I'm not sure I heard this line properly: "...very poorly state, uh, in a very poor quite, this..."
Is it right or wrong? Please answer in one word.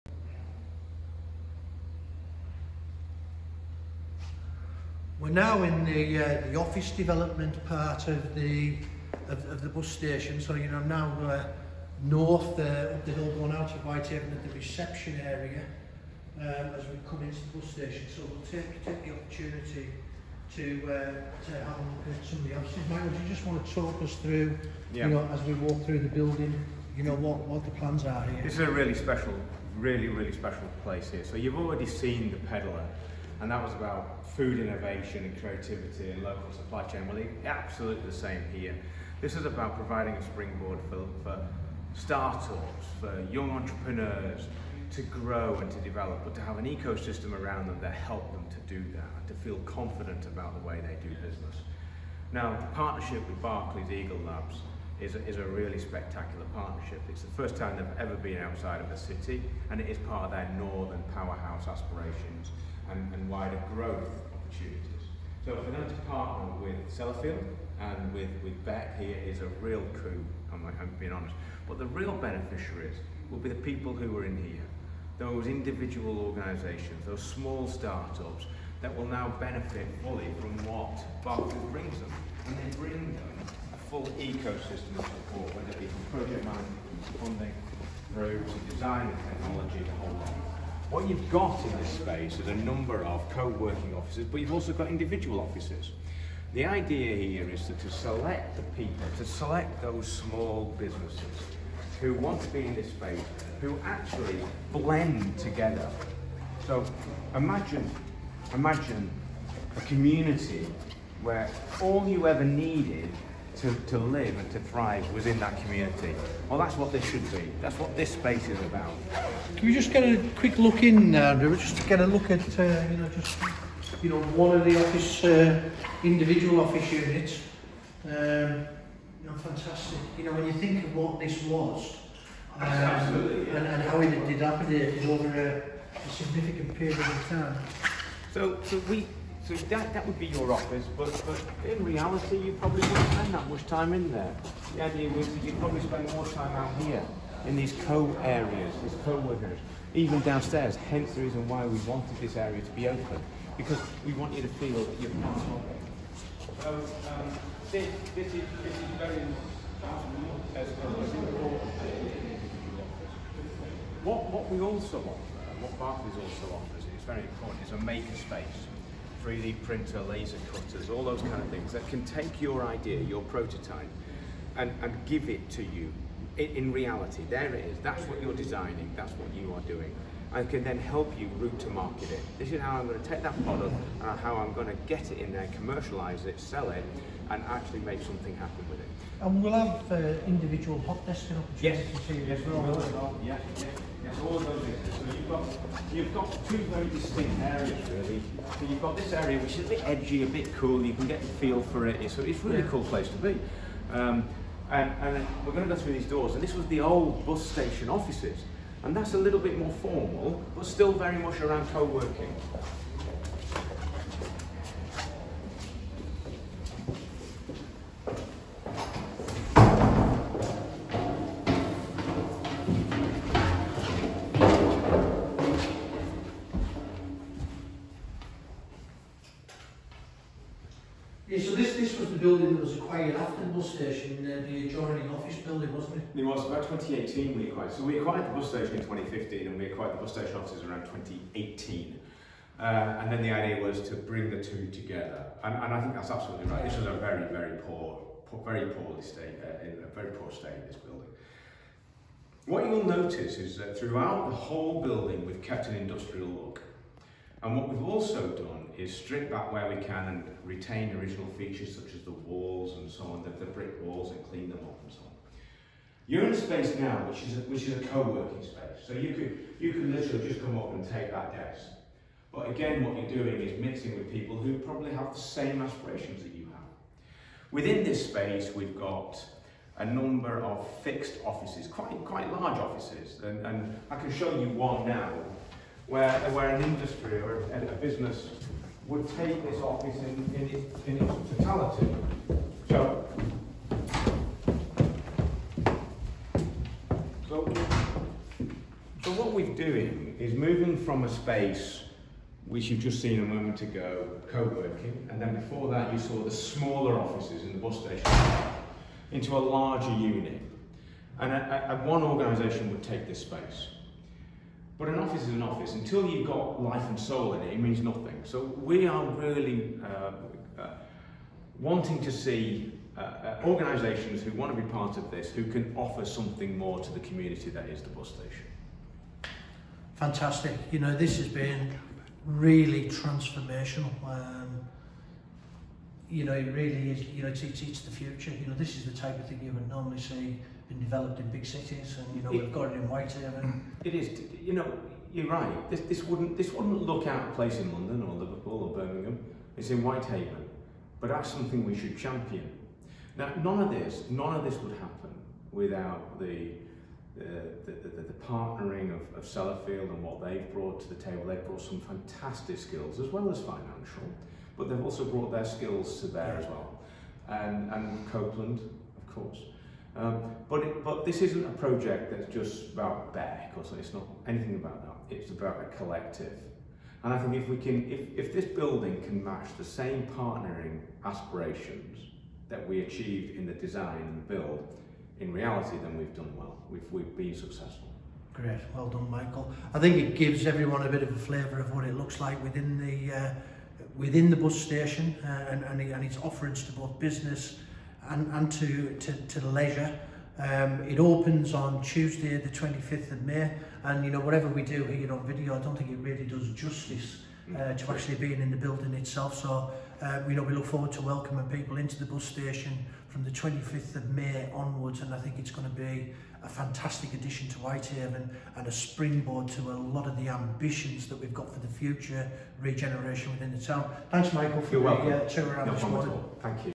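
wrong.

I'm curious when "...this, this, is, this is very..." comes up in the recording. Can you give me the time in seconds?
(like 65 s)
157 s.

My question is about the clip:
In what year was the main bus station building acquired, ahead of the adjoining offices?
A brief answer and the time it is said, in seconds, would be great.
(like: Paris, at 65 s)
2015, at 238 s.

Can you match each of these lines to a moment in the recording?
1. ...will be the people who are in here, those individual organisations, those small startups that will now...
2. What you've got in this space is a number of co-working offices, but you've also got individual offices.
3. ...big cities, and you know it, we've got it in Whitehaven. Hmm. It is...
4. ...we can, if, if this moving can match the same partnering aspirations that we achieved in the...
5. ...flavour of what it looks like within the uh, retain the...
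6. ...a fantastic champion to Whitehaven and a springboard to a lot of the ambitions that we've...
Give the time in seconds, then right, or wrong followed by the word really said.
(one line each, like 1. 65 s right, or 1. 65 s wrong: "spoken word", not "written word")
1. 73 s right
2. 90 s right
3. 341 s right
4. 377 s wrong: "building", not "moving"
5. 391 s wrong: "within", not "retain"
6. 416 s wrong: "addition", not "champion".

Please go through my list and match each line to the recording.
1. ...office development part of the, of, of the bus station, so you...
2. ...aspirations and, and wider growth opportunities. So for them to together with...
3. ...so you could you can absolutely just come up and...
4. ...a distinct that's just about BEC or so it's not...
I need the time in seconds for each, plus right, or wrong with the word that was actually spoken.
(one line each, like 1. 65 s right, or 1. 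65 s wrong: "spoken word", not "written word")
1. 6 s right
2. 61 s wrong: "partner", not "together"
3. 268 s wrong: "literally", not "absolutely"
4. 371 s wrong: "project", not "distinct".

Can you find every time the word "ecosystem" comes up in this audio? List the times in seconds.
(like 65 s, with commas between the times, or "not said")
46 s, 84 s.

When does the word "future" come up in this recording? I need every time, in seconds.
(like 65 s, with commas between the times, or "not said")
337 s, 421 s.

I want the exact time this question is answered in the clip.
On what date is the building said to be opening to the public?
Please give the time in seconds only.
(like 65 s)
401 s.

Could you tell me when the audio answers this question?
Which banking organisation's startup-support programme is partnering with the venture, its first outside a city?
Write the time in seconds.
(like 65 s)
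53 s.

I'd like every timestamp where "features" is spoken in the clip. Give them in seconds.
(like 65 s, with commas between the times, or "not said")
261 s.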